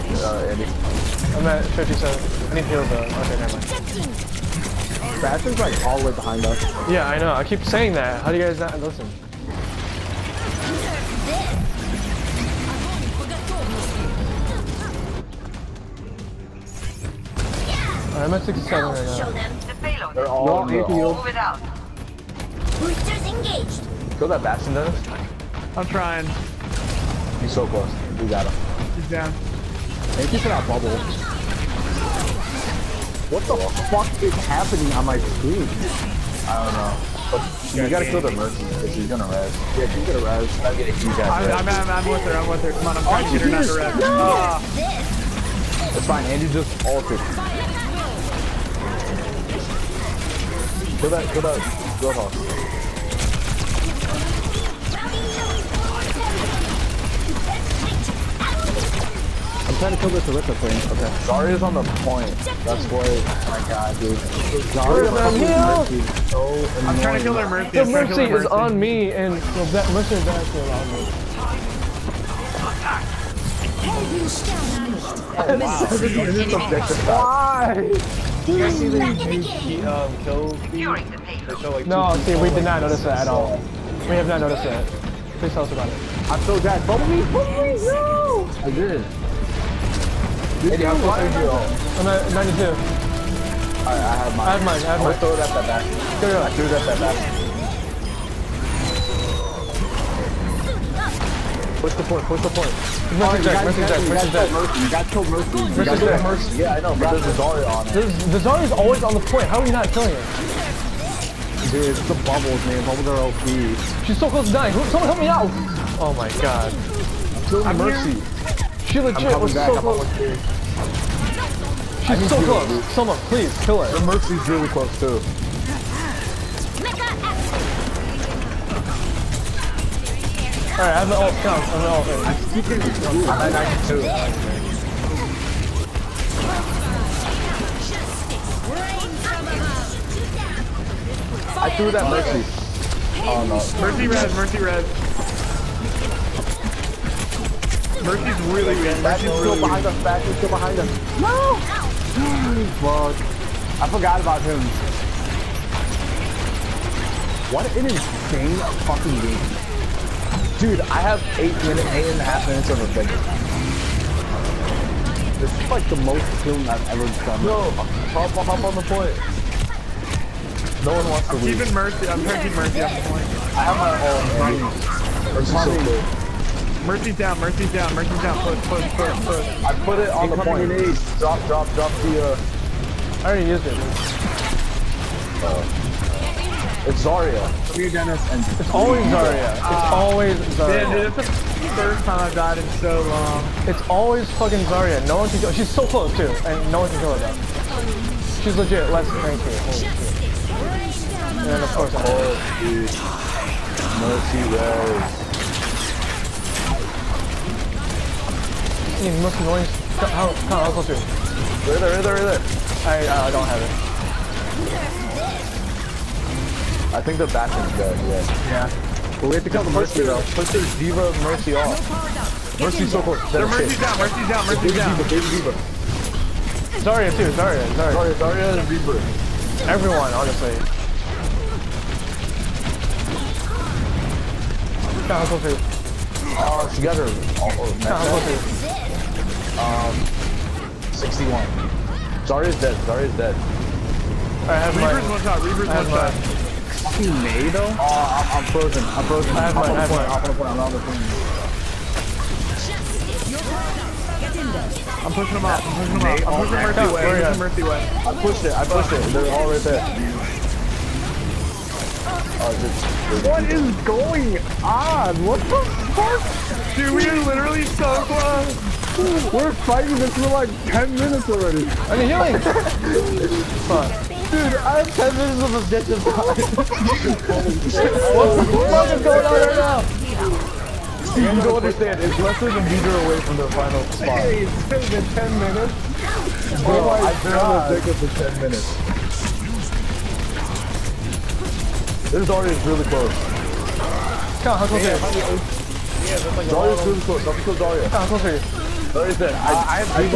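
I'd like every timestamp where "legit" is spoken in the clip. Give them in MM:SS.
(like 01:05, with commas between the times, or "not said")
01:58, 03:18.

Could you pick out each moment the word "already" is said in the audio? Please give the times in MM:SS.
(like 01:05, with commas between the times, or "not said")
03:03, 04:31, 04:52.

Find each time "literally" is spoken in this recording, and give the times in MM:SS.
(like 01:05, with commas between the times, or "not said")
04:27.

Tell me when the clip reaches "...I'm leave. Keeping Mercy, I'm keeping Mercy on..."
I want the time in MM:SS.
02:51.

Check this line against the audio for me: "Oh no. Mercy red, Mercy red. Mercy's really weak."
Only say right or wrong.
right.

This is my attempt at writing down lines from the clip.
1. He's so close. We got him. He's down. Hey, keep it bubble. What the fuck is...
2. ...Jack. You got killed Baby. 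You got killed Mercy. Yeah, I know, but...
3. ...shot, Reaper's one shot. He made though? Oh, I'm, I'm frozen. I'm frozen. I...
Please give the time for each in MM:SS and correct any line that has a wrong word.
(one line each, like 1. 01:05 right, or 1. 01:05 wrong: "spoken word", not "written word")
1. 00:27 right
2. 01:44 wrong: "Mercy", not "Baby"
3. 04:05 right.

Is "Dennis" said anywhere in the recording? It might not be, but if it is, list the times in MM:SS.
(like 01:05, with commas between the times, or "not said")
00:24, 03:07.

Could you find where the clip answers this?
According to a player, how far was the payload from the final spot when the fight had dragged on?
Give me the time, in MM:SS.
04:42.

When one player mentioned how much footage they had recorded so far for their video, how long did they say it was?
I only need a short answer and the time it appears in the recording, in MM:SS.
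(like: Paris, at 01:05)
8 and a half minutes, at 02:41.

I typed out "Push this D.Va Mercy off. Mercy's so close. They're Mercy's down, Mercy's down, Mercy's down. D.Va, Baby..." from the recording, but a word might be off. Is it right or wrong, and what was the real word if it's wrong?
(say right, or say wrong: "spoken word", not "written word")
right.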